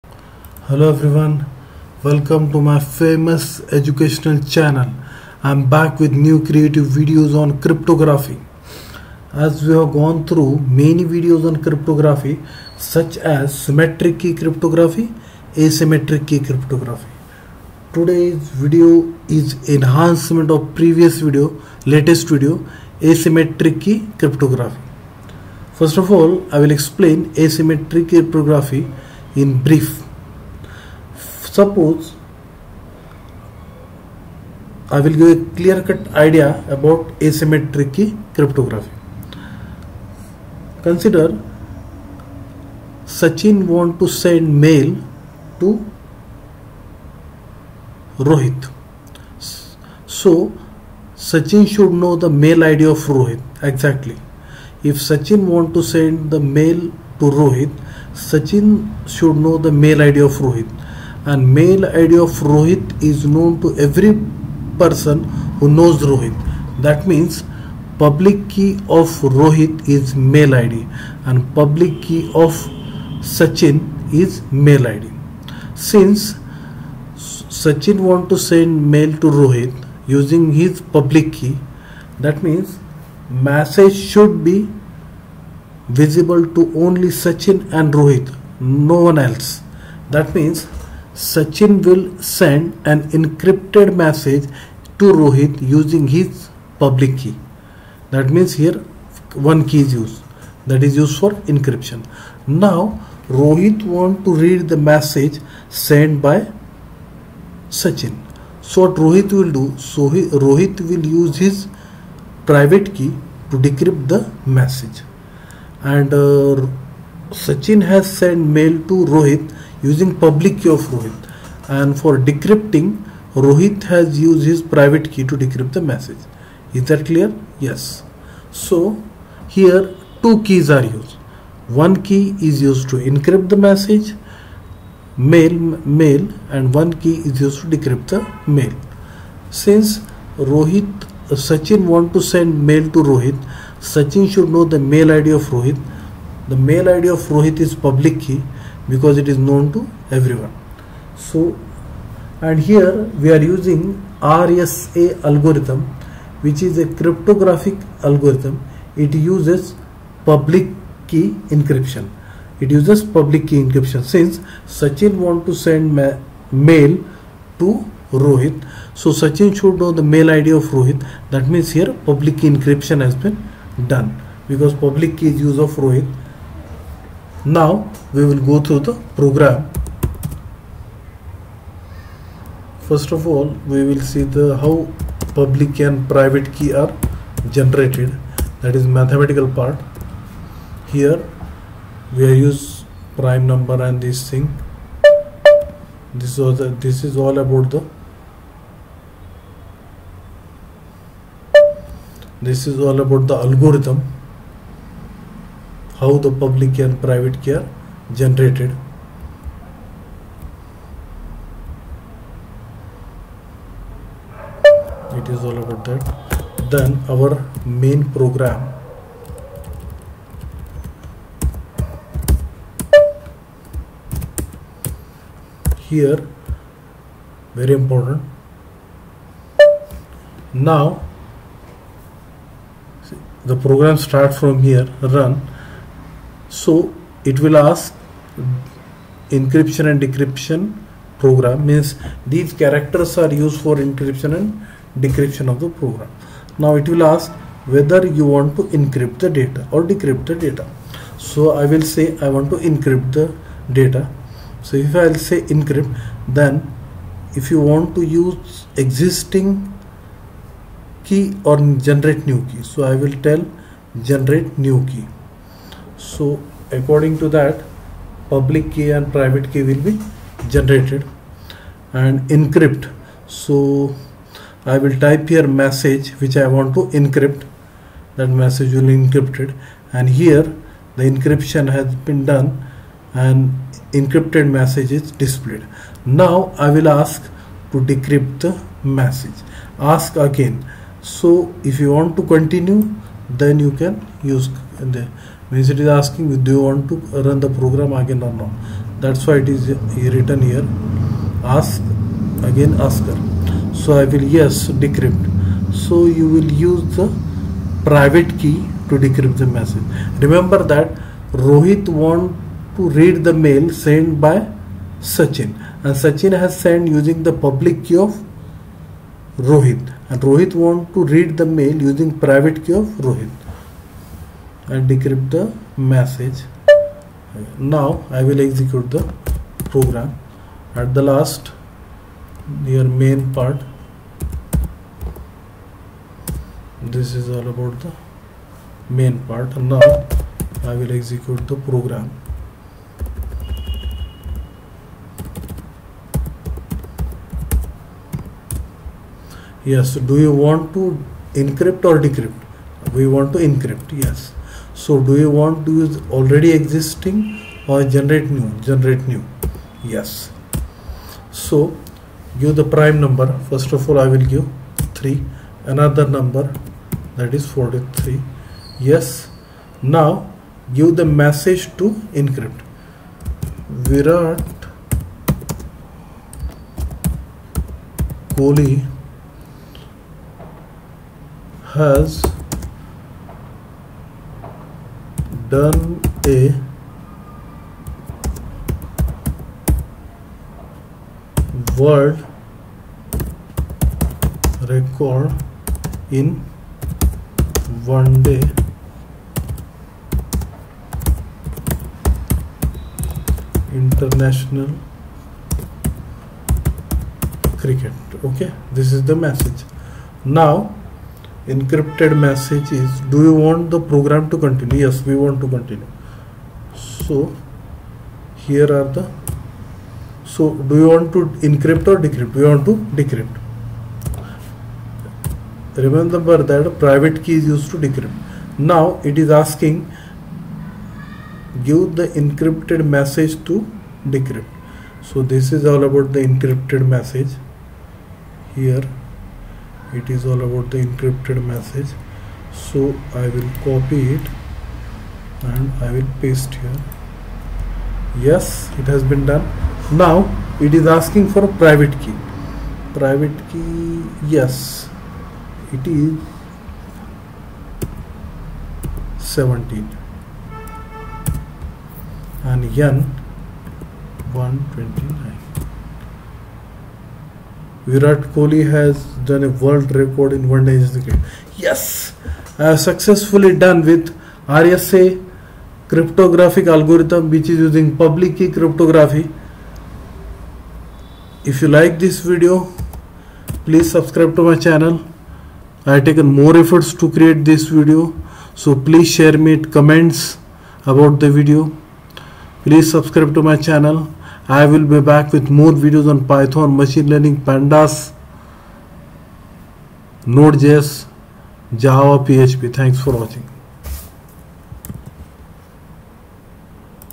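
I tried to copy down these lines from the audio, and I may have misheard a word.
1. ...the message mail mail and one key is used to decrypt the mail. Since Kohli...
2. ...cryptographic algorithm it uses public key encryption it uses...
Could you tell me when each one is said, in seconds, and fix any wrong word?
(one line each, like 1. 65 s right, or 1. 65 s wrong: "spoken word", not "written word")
1. 133 s wrong: "Rohit", not "Kohli"
2. 156 s right.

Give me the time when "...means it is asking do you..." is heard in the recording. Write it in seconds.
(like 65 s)
295 s.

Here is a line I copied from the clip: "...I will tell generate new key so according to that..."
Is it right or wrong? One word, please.
right.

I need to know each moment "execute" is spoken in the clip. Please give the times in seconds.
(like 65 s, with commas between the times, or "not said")
328 s, 340 s.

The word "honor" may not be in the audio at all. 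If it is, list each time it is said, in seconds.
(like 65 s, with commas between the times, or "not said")
not said.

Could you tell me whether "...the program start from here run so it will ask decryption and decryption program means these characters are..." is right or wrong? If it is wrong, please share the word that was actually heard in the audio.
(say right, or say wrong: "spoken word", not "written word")
wrong: "encryption", not "decryption".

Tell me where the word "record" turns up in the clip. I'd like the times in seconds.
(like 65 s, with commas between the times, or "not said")
394 s, 469 s.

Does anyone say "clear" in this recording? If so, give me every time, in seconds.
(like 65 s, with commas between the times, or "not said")
35 s, 127 s.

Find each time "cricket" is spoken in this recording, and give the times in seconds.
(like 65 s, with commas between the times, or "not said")
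407 s, 470 s.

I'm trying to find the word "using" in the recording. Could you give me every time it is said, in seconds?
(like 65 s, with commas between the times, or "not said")
80 s, 95 s, 119 s, 153 s, 316 s, 321 s, 477 s.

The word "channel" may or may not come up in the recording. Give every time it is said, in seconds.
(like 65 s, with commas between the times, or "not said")
4 s, 484 s, 493 s.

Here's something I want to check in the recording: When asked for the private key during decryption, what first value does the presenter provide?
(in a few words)
17.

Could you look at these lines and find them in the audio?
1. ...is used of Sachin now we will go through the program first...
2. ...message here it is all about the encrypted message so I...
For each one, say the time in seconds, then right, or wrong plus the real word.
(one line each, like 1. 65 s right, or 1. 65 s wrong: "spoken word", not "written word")
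1. 175 s wrong: "Rohit", not "Sachin"
2. 436 s right.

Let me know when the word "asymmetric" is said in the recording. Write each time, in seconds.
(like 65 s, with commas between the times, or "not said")
15 s, 22 s, 27 s, 37 s.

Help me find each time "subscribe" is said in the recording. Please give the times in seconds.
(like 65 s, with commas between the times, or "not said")
483 s, 492 s.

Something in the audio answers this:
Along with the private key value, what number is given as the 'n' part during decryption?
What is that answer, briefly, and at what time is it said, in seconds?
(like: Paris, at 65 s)
129, at 464 s.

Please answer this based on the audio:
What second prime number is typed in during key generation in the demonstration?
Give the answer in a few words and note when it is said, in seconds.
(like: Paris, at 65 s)
43, at 367 s.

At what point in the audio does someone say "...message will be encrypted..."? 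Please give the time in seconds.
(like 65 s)
278 s.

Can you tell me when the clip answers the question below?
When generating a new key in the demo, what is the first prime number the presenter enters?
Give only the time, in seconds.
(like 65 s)
365 s.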